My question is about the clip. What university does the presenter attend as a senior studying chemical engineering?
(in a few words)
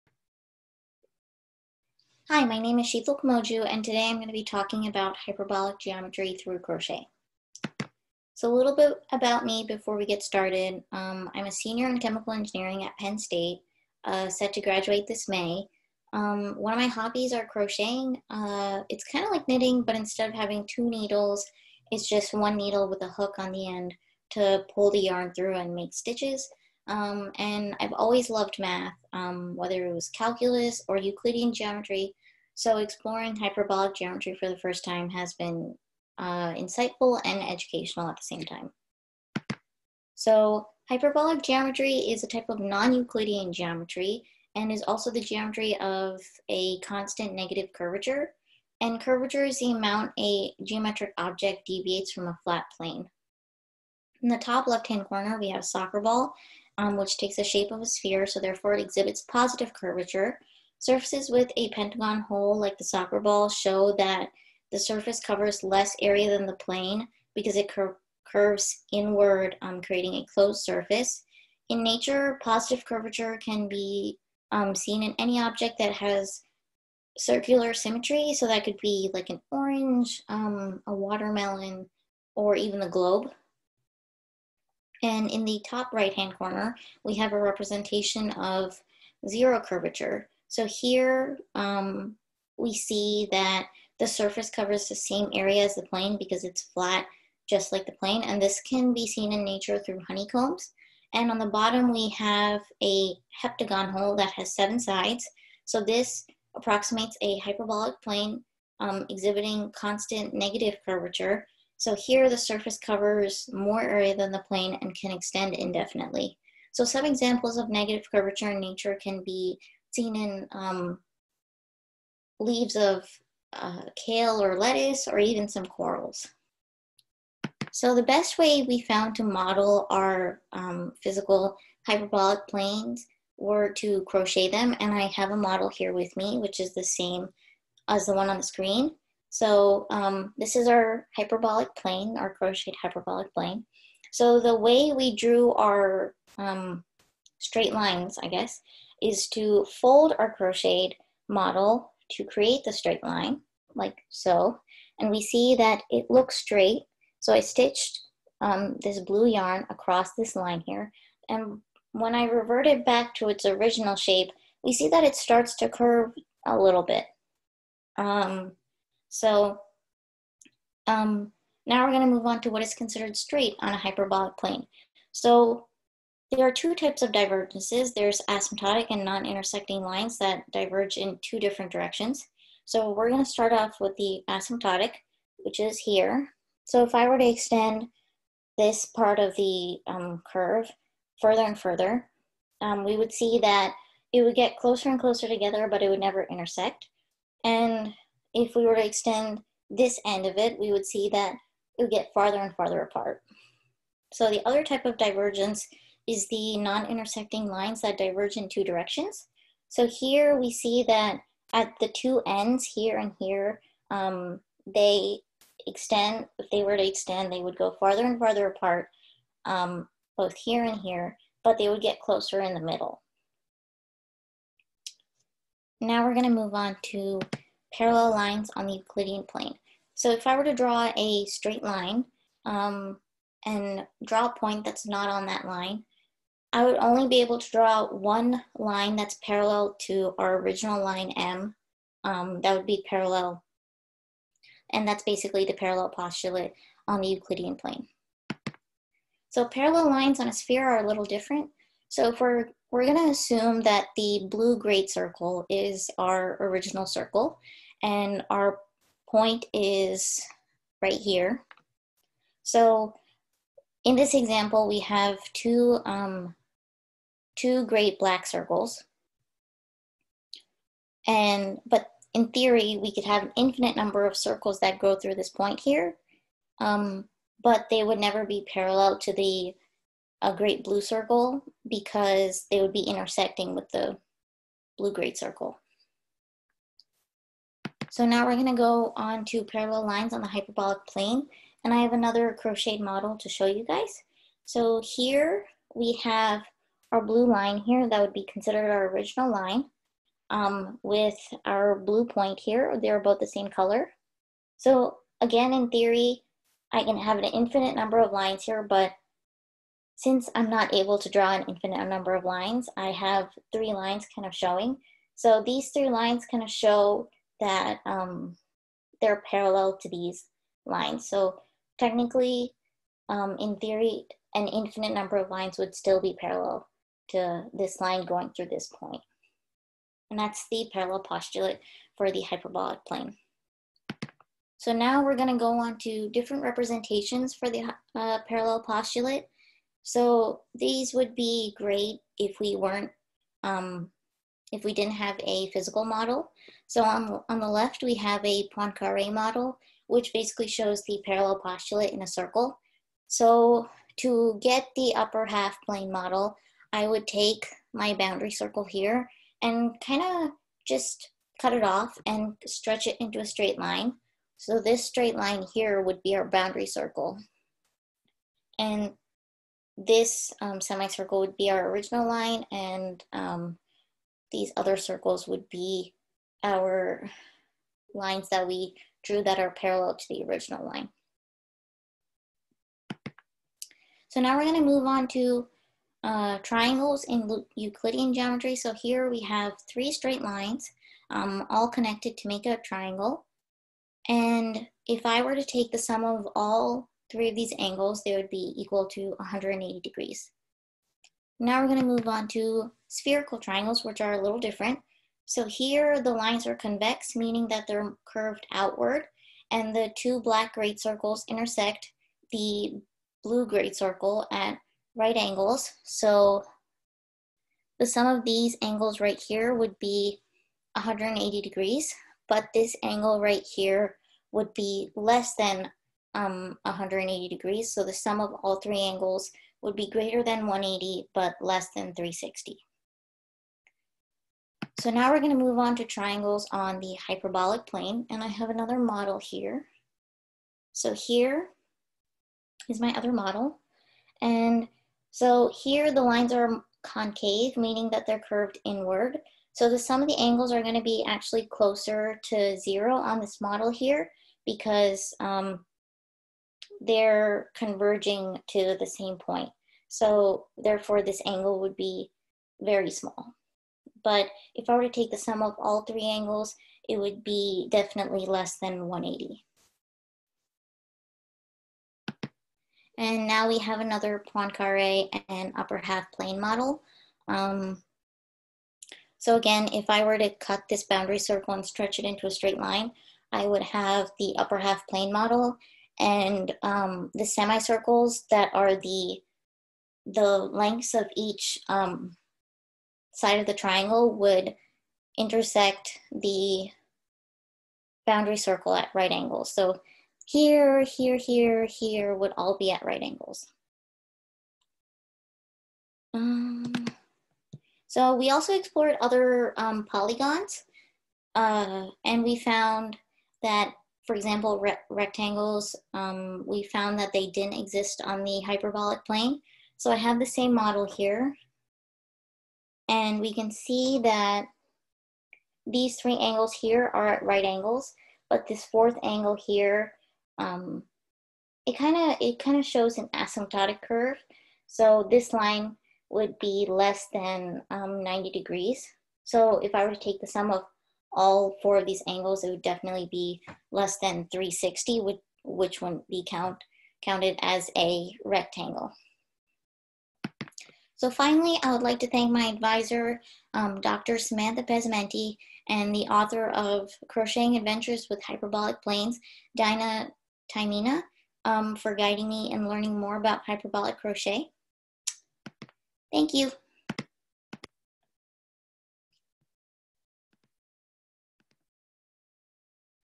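Penn State.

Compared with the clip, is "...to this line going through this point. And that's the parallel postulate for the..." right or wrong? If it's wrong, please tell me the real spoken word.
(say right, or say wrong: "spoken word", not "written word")
right.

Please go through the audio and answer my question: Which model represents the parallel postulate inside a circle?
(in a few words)
Poincaré model.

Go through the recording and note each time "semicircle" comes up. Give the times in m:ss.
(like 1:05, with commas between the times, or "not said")
6:10, 8:07.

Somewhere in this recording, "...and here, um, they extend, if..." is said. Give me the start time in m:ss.
3:32.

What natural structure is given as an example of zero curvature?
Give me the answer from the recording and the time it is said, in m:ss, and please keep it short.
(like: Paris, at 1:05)
Honeycombs, at 1:40.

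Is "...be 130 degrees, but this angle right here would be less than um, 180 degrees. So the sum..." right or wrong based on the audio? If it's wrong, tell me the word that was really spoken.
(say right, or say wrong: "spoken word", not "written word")
wrong: "180", not "130".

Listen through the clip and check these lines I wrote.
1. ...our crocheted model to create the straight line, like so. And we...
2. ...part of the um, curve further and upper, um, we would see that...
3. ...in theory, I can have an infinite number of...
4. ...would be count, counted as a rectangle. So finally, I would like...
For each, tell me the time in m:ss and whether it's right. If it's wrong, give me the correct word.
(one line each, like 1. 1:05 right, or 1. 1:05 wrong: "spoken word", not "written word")
1. 2:30 right
2. 3:08 wrong: "further", not "upper"
3. 5:05 right
4. 9:05 right.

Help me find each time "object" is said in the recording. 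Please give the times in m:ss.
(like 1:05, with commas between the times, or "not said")
0:51, 1:15.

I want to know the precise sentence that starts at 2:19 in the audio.
So um, this is our hyperbolic plane, our crocheted hyperbolic plane.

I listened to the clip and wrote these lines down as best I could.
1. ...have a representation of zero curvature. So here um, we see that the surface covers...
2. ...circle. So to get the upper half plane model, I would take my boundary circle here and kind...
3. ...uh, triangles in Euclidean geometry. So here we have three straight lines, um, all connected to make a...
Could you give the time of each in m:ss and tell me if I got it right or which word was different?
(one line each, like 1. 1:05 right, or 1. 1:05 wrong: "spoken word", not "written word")
1. 1:27 right
2. 5:52 right
3. 6:26 right.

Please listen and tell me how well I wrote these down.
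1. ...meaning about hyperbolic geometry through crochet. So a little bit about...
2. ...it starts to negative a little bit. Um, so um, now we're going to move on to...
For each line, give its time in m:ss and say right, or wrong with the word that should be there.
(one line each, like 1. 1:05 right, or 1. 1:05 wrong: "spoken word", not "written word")
1. 0:04 wrong: "talking", not "meaning"
2. 2:45 wrong: "curve", not "negative".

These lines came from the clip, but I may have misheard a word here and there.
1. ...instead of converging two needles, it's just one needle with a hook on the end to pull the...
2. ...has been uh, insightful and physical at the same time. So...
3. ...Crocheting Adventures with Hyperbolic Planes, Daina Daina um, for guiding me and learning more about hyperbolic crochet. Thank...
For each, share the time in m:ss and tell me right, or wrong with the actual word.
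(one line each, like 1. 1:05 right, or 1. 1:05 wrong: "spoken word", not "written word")
1. 0:19 wrong: "having", not "converging"
2. 0:35 wrong: "educational", not "physical"
3. 9:17 wrong: "Taimina", not "Daina".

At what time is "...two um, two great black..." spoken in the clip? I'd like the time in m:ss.
4:25.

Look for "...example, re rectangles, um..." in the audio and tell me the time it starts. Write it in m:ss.
8:34.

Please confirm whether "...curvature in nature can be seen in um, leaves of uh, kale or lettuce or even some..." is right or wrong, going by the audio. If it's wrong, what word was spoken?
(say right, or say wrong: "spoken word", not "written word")
right.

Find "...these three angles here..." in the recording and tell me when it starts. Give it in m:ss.
8:45.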